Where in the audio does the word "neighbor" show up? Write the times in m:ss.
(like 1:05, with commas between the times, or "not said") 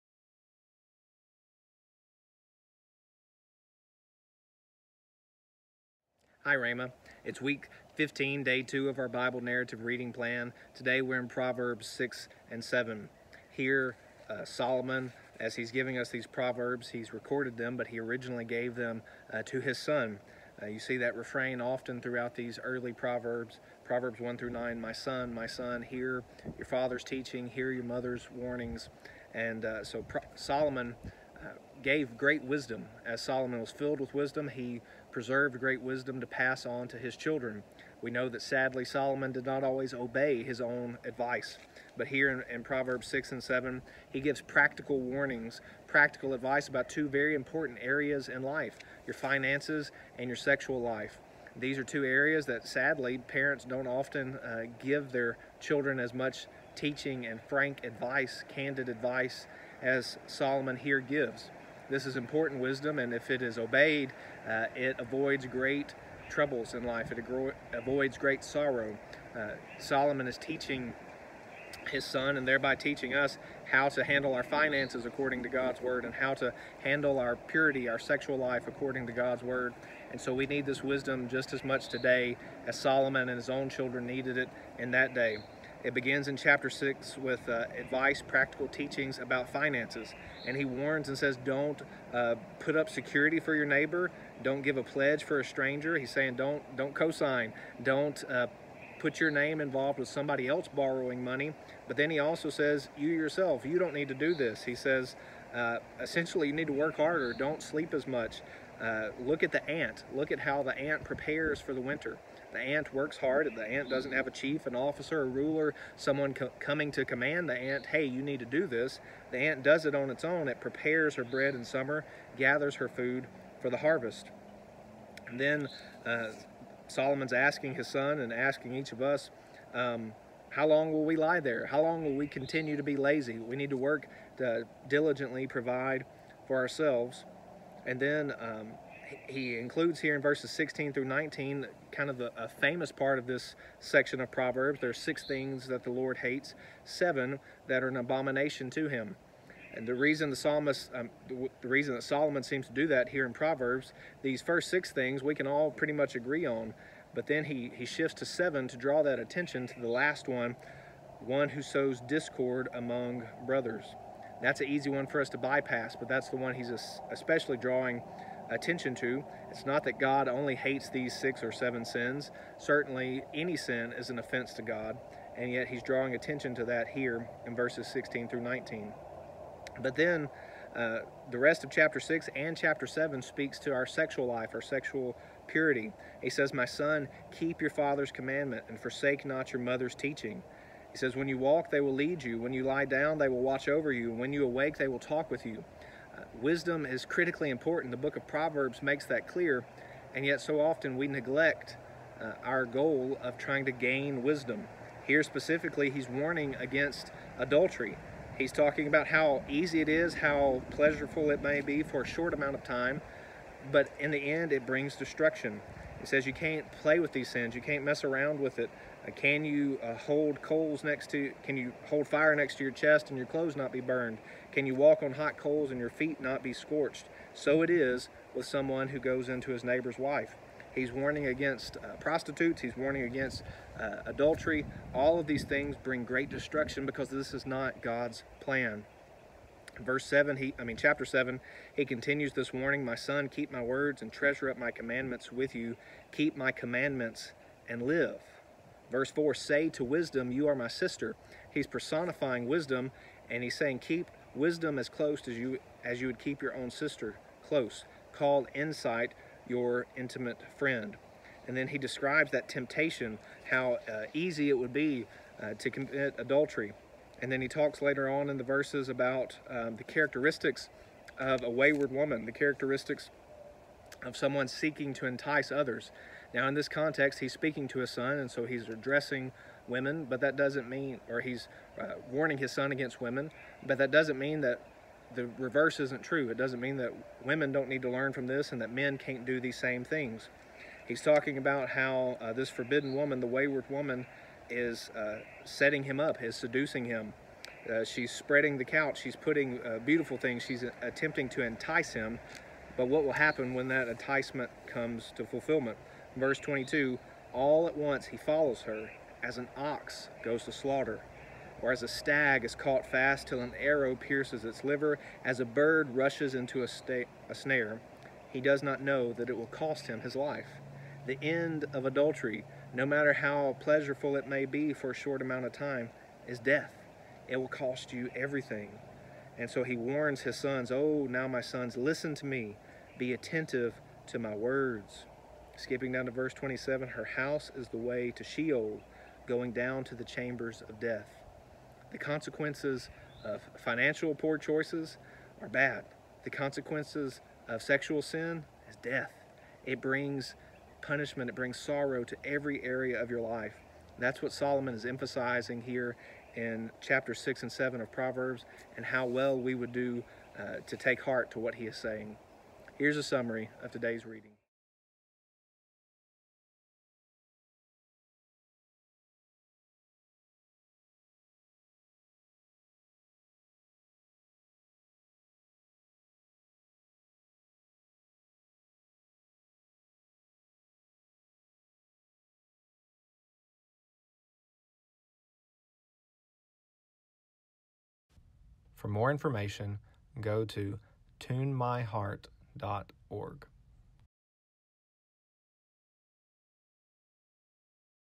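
1:33, 3:49.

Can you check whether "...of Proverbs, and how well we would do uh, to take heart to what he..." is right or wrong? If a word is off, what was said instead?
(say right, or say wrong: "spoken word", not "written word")
right.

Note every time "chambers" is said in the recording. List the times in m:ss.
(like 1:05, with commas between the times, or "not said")
5:40.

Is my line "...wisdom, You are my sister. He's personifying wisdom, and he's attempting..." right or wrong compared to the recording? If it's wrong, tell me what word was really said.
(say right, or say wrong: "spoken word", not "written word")
wrong: "saying", not "attempting".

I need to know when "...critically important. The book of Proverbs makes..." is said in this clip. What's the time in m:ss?
3:17.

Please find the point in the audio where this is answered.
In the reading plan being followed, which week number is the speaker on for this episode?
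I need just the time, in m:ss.
0:07.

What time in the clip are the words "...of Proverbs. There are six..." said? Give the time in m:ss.
2:24.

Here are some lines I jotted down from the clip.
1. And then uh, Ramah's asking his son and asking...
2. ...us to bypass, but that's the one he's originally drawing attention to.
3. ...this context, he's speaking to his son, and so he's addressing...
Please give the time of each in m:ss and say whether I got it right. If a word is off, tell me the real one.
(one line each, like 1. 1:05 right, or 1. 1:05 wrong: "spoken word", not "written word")
1. 2:05 wrong: "Solomon", not "Ramah"
2. 2:45 wrong: "especially", not "originally"
3. 4:36 right.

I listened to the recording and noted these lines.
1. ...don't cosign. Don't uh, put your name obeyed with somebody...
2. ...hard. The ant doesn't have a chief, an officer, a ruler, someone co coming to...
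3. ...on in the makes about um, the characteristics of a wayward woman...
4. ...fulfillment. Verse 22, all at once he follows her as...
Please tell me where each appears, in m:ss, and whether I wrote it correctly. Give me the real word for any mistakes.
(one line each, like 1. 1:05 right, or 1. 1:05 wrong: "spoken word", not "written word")
1. 1:36 wrong: "involved", not "obeyed"
2. 1:53 right
3. 4:28 wrong: "verses", not "makes"
4. 5:05 right.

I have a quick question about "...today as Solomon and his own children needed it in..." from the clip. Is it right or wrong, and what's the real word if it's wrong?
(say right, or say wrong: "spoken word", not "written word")
right.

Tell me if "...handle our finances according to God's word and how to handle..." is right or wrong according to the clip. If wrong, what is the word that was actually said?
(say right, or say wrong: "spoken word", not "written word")
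right.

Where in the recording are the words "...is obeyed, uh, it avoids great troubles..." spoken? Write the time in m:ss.
1:03.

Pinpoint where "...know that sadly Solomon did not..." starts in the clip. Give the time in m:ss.
0:38.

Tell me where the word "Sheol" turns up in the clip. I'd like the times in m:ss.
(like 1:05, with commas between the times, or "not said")
5:38.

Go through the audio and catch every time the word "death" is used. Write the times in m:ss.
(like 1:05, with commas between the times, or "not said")
5:26, 5:40, 5:48.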